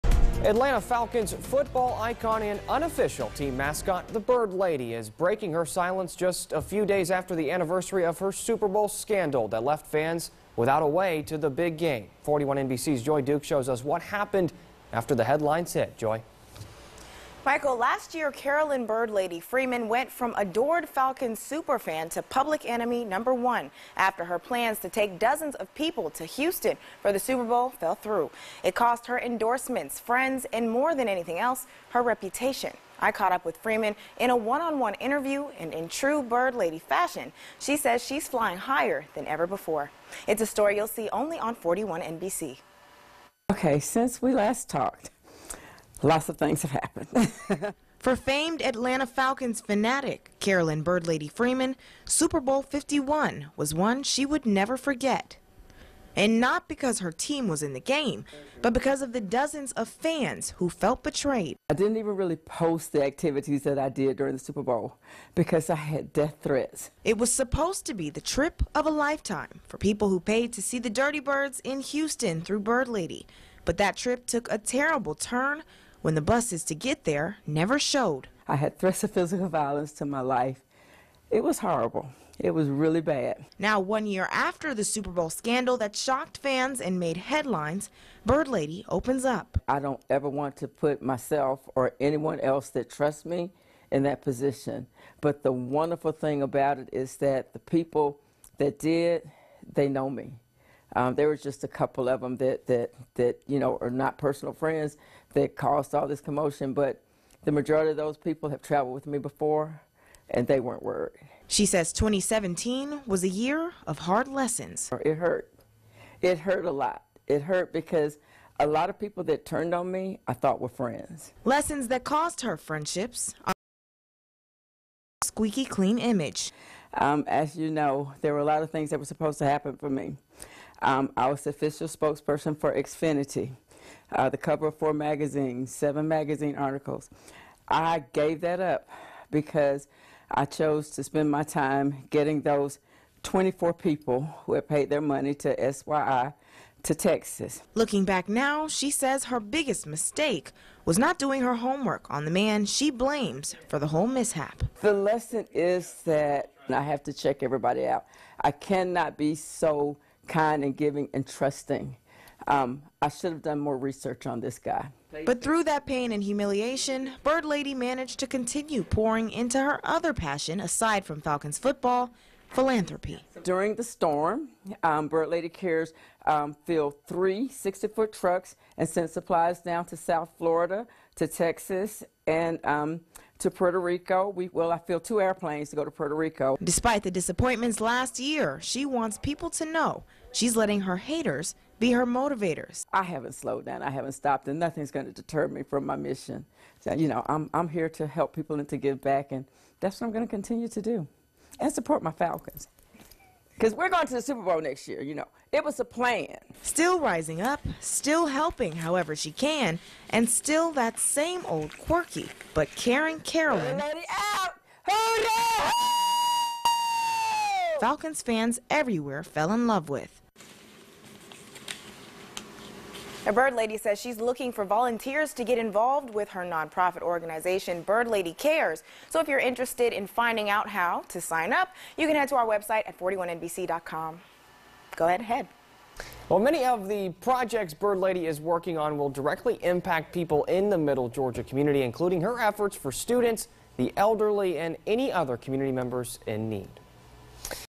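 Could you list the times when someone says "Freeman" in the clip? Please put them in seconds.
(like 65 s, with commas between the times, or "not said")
19 s, 33 s, 51 s.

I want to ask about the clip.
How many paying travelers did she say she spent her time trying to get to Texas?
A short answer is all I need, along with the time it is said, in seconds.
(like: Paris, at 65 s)
24, at 143 s.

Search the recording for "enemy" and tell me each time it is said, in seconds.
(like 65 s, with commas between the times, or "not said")
22 s.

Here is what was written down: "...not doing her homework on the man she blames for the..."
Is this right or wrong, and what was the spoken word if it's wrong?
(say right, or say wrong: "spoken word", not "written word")
right.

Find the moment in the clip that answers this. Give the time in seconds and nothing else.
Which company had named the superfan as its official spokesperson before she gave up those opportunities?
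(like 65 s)
132 s.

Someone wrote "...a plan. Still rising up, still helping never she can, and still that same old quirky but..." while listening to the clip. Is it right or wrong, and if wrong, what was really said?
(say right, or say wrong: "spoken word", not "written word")
wrong: "however", not "never".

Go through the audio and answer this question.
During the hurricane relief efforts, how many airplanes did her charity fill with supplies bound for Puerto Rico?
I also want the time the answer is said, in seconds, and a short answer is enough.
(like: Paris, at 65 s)
2, at 185 s.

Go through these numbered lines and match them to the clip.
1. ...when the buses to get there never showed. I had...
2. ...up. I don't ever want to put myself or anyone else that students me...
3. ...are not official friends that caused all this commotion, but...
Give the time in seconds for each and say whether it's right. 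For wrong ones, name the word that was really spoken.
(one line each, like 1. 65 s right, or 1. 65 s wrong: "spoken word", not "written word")
1. 76 s right
2. 89 s wrong: "trusts", not "students"
3. 103 s wrong: "personal", not "official".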